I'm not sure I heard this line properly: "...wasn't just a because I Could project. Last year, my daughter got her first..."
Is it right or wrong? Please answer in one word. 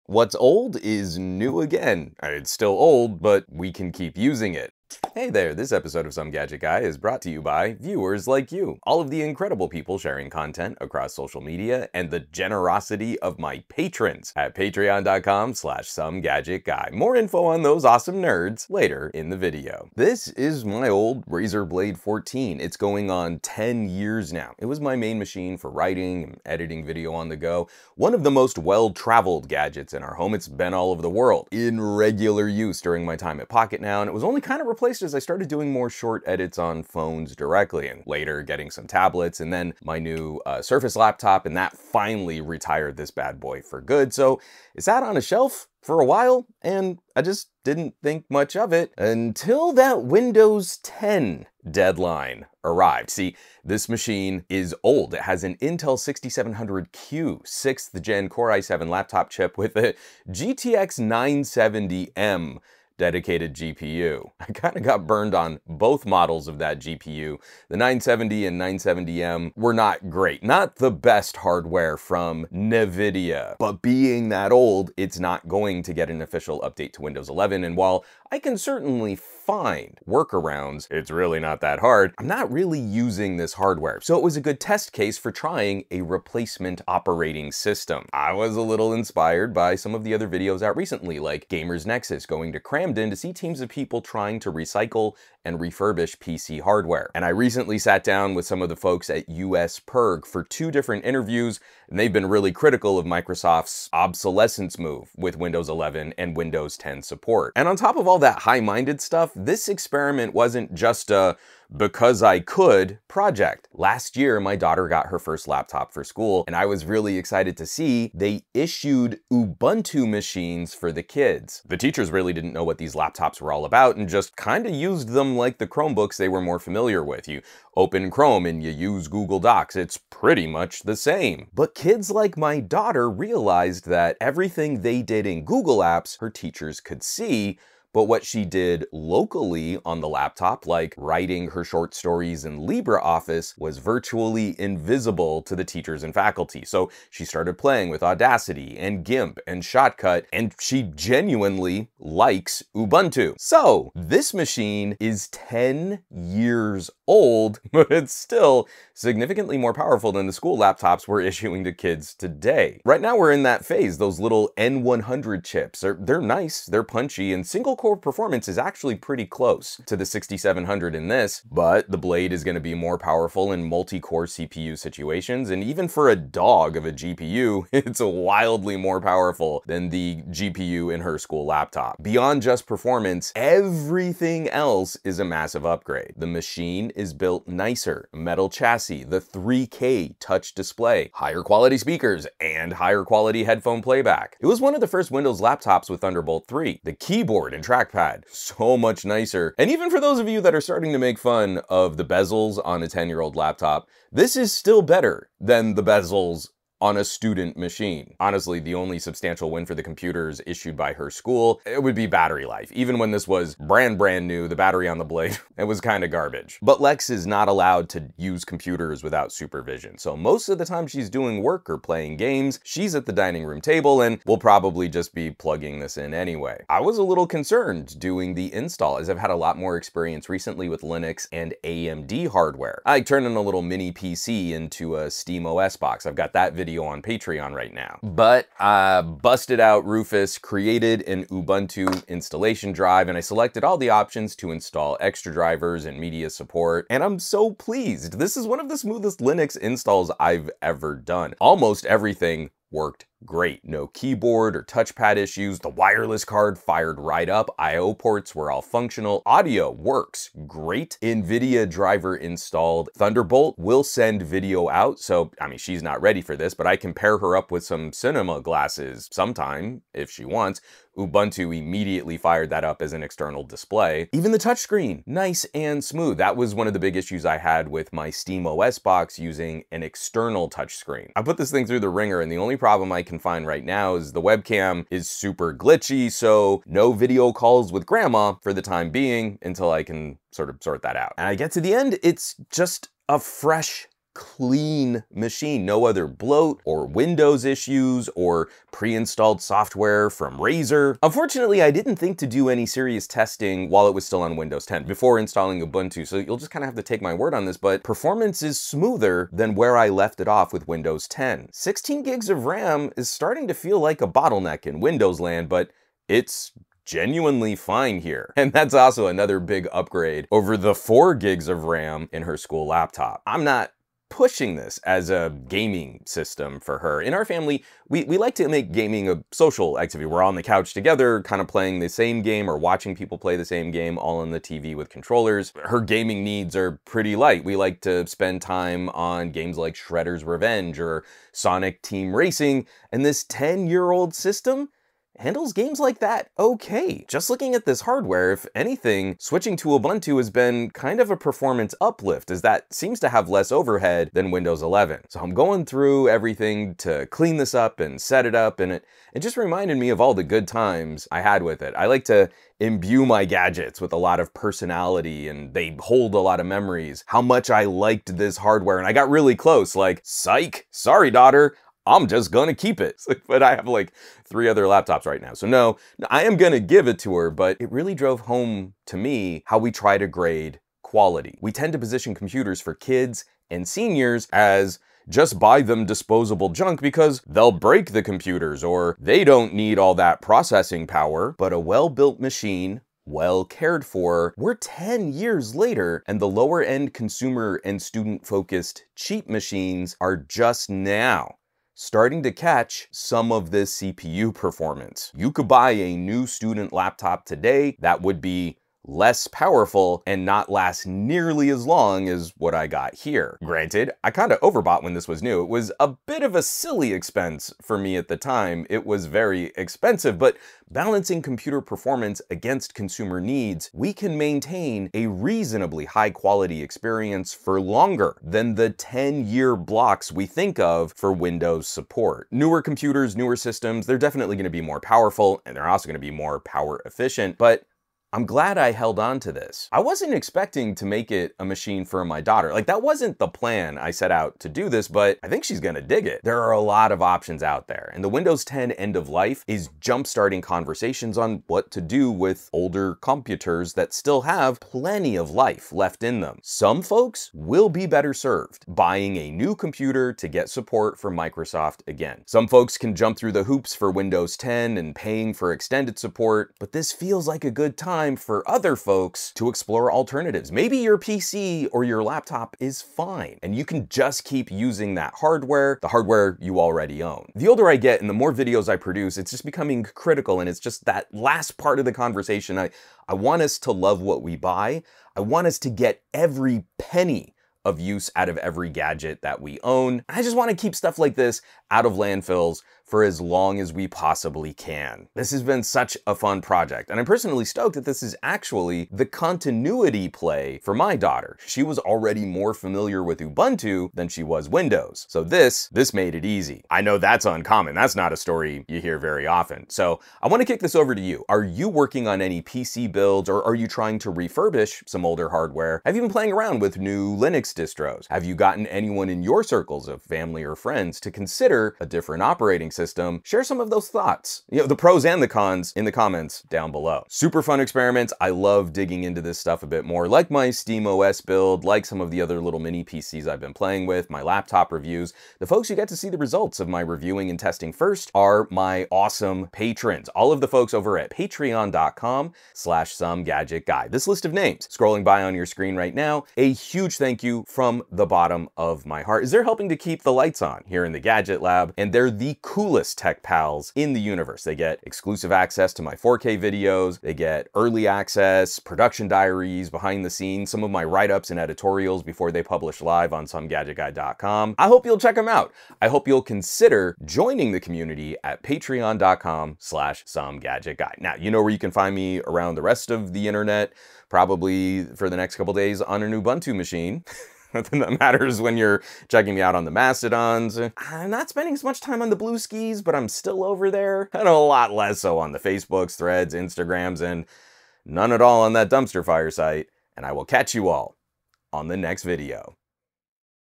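right.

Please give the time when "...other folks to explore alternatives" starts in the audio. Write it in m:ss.
7:48.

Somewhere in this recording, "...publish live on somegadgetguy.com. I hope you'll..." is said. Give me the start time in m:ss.
9:22.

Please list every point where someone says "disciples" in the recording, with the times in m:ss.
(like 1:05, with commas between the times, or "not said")
not said.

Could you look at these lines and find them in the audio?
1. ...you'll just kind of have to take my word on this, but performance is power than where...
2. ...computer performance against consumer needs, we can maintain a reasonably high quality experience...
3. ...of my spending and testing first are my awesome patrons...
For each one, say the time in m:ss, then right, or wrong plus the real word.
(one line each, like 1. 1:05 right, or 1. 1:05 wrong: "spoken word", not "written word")
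1. 5:06 wrong: "smoother", not "power"
2. 7:01 right
3. 8:56 wrong: "reviewing", not "spending".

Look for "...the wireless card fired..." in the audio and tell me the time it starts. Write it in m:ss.
4:15.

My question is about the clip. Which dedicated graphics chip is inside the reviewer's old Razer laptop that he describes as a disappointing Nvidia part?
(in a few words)
GTX 970M.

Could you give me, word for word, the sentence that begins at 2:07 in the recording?
You open Chrome and you use Google Docs.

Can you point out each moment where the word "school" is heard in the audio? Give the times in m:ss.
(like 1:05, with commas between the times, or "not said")
1:56, 2:40, 3:01, 3:31, 5:22.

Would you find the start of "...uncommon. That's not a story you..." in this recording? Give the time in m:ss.
8:27.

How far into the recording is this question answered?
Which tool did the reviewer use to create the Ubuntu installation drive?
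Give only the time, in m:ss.
3:59.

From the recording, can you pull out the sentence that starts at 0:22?
It's going on 10 years now.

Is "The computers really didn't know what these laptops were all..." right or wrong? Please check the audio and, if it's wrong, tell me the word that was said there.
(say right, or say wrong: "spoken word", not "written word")
wrong: "teachers", not "computers".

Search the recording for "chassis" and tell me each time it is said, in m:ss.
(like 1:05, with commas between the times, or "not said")
3:08.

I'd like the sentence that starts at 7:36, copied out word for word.
Some folks will be better served buying a new computer to get support from Microsoft again.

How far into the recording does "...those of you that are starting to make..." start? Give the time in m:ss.
3:20.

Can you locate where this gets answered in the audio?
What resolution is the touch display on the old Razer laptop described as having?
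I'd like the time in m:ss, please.
3:09.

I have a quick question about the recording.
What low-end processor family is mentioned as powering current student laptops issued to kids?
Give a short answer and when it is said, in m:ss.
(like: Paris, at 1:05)
N100, at 2:44.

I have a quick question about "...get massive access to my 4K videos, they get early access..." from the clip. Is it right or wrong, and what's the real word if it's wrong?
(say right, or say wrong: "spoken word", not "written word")
wrong: "exclusive", not "massive".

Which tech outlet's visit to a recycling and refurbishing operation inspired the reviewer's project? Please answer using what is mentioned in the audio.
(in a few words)
Gamers Nexus.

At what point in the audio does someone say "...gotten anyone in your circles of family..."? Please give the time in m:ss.
8:38.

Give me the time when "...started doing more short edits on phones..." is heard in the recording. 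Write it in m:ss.
0:35.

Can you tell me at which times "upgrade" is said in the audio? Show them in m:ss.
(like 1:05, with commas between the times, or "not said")
3:05, 5:19.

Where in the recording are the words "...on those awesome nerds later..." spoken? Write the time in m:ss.
0:17.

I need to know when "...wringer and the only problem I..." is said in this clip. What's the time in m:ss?
4:41.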